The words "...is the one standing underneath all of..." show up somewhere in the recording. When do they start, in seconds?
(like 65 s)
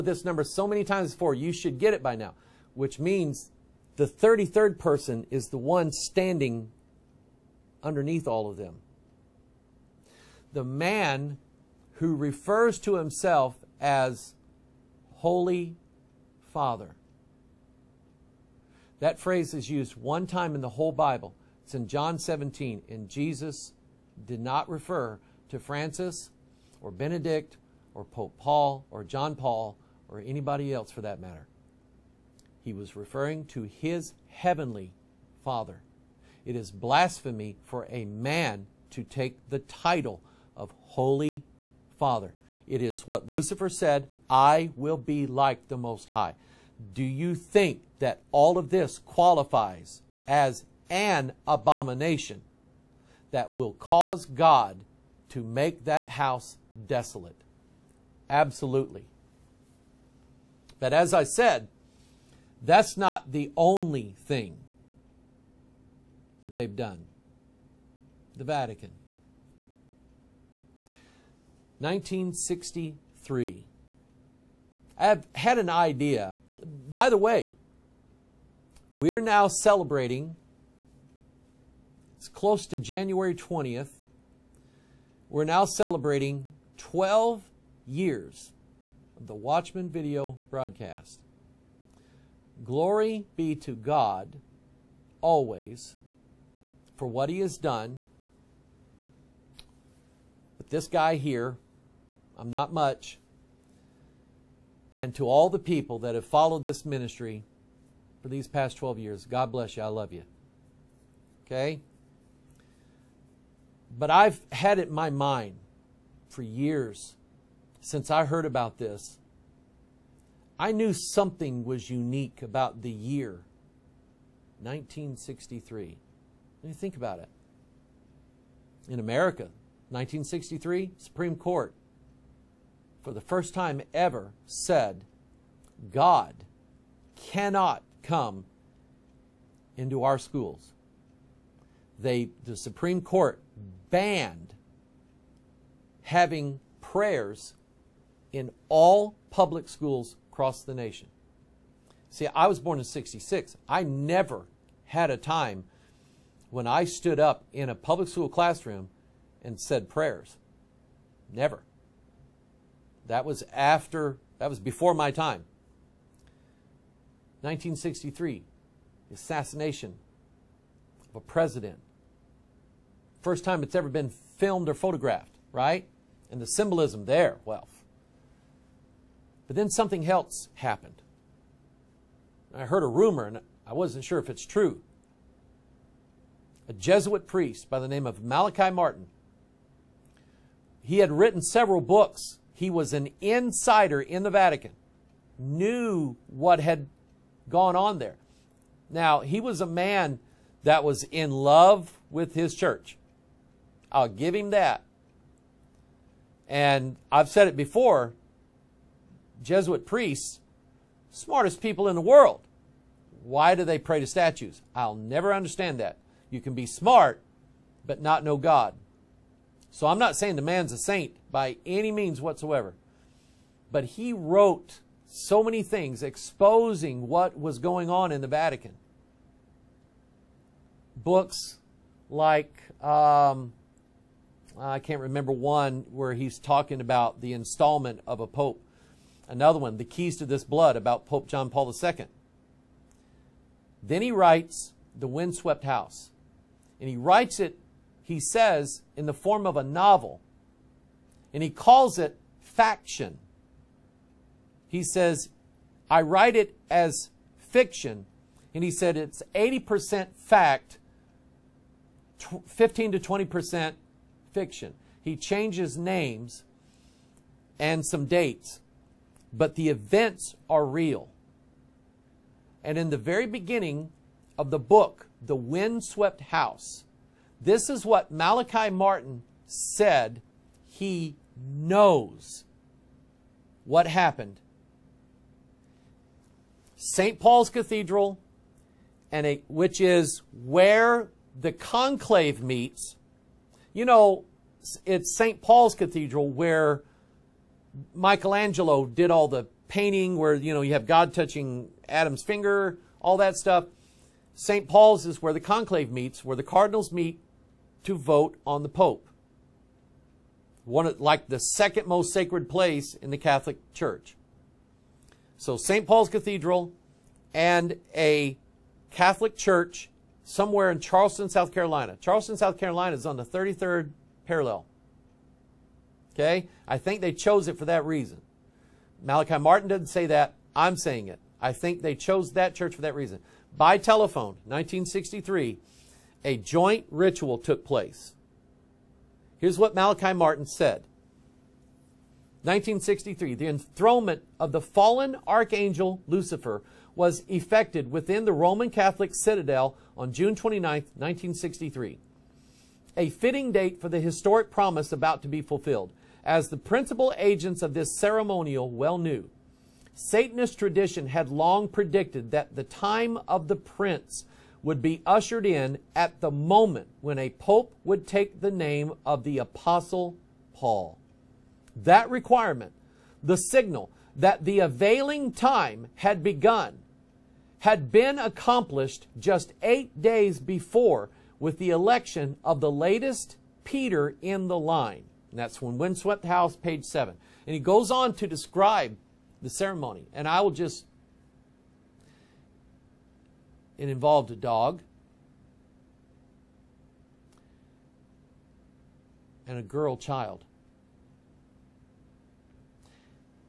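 5 s.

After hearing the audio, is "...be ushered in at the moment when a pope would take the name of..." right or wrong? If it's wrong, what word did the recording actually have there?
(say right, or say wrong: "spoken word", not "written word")
right.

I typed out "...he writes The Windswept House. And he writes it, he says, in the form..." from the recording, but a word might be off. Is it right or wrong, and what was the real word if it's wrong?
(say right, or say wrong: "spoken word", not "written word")
right.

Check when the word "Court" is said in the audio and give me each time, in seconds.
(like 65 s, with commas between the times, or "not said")
131 s, 143 s.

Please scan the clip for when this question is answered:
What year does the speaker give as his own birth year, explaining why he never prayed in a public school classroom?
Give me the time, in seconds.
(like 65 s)
152 s.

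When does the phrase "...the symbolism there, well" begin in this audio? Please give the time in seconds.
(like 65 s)
176 s.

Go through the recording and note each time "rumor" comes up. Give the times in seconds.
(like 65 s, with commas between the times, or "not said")
182 s.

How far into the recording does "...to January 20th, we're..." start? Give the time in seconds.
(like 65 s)
82 s.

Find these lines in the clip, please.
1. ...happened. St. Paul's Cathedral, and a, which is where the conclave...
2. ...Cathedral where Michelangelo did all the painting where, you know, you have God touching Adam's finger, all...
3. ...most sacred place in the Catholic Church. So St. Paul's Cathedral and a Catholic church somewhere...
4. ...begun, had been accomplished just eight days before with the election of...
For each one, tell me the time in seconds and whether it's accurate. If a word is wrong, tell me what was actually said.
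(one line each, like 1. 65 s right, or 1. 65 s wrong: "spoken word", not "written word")
1. 283 s right
2. 295 s right
3. 311 s right
4. 376 s right.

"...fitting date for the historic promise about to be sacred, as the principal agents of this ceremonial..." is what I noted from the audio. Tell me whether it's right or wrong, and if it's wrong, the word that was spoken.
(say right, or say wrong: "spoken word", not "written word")
wrong: "fulfilled", not "sacred".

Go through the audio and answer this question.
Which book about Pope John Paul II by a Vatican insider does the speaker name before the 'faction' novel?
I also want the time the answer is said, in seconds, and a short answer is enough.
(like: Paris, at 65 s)
The Keys to This Blood, at 239 s.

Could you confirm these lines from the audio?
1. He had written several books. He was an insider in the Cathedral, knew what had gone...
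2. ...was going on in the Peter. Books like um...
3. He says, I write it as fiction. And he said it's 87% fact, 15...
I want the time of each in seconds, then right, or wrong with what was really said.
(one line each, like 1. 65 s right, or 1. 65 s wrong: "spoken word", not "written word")
1. 190 s wrong: "Vatican", not "Cathedral"
2. 227 s wrong: "Vatican", not "Peter"
3. 254 s wrong: "80", not "87".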